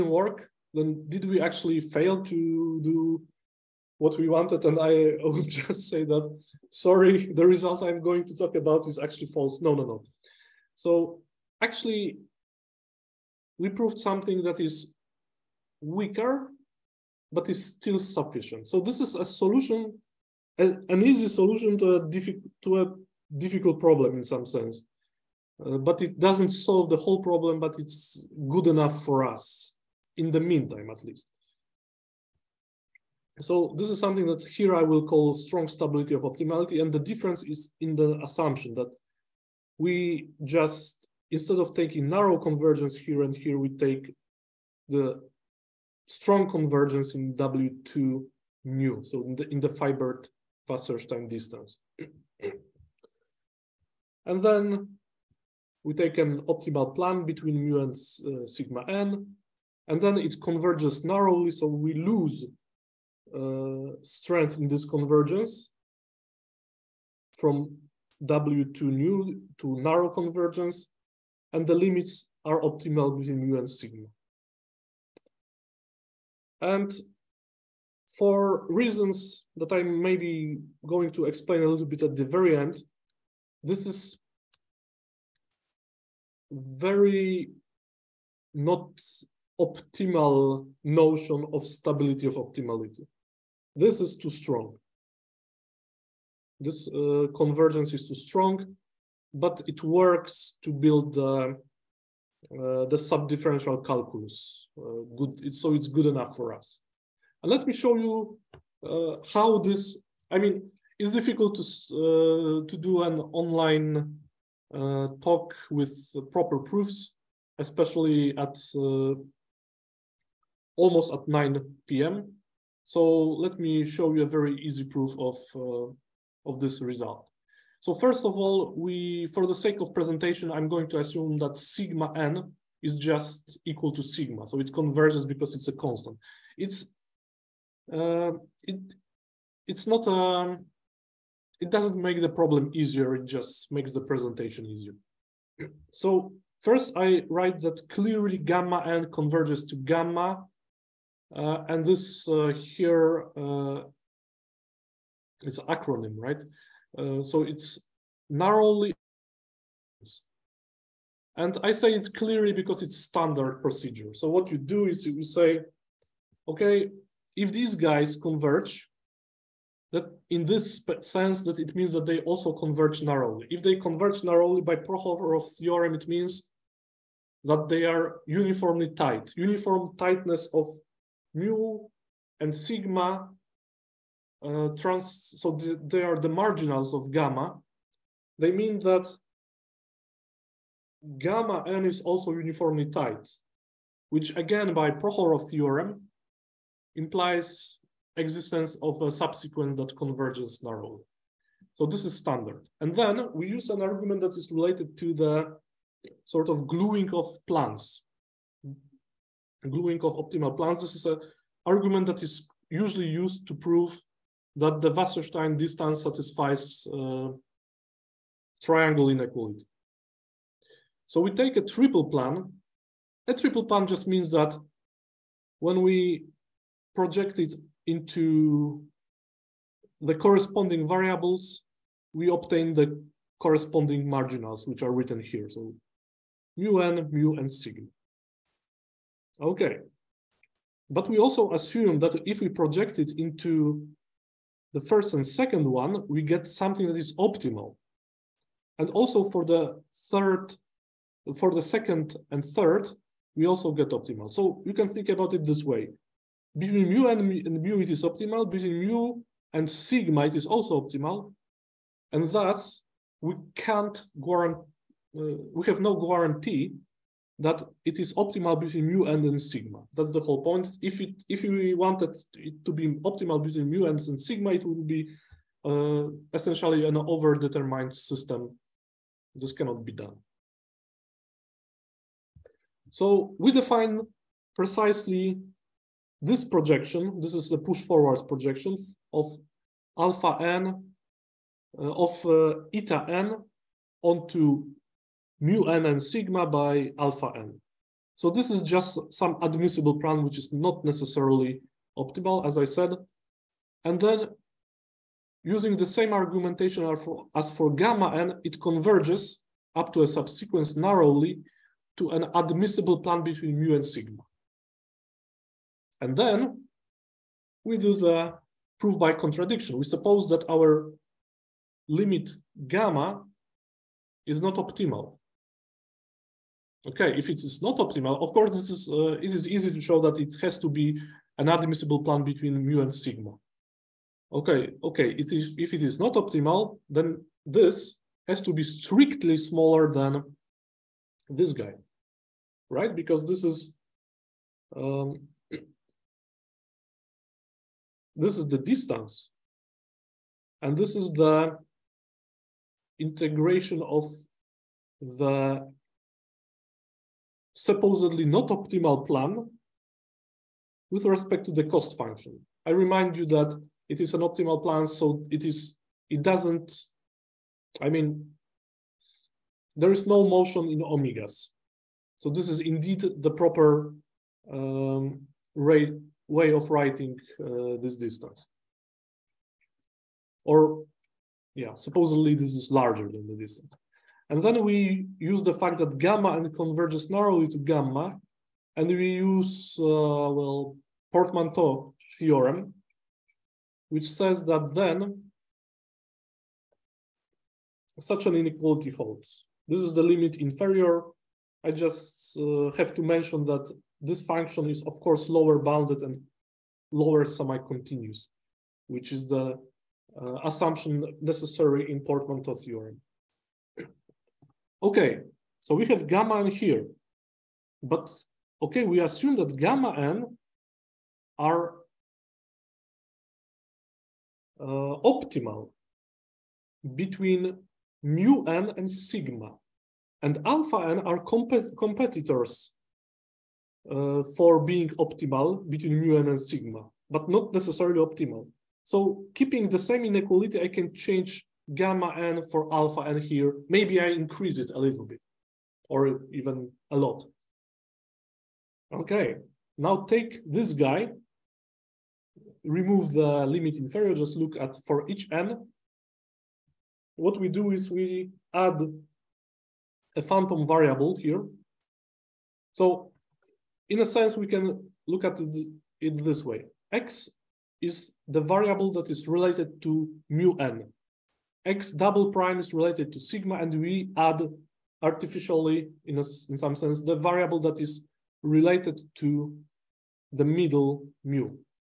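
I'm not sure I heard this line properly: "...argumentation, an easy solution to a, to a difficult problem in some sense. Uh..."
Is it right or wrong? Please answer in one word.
wrong.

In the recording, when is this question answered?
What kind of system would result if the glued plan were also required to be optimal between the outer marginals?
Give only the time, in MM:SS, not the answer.
04:36.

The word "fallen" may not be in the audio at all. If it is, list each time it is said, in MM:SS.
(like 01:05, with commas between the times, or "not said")
not said.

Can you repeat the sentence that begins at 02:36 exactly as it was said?
Uh, so it's narrowly, and I say it's clearly because it's standard procedure.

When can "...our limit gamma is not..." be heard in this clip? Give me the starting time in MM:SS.
05:20.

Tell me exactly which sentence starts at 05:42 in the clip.
Because this is um, this is the distance.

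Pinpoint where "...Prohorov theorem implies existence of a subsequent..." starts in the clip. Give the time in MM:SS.
03:14.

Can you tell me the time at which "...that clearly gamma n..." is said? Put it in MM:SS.
02:27.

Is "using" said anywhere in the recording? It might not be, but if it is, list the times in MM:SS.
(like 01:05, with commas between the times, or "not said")
05:05.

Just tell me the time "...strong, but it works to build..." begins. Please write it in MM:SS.
01:38.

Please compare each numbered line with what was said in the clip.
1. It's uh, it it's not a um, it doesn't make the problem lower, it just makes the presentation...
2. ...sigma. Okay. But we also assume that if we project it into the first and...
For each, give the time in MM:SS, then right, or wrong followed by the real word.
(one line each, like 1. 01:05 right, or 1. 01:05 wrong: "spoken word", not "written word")
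1. 02:16 wrong: "easier", not "lower"
2. 03:57 right.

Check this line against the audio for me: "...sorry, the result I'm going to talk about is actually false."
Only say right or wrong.
right.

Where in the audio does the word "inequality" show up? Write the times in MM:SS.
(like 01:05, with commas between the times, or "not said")
03:39, 06:38, 07:20.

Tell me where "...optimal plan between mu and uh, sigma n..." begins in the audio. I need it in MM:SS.
00:56.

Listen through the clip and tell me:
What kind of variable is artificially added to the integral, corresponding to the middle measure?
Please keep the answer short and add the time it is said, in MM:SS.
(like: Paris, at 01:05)
phantom variable, at 07:40.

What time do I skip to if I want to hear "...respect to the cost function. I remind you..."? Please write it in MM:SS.
06:01.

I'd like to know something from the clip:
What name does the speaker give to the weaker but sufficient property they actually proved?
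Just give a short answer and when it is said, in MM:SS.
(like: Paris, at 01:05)
strong stability of optimality, at 00:35.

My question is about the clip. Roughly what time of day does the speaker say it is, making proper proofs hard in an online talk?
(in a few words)
9 p.m.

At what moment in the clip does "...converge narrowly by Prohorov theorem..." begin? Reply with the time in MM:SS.
02:53.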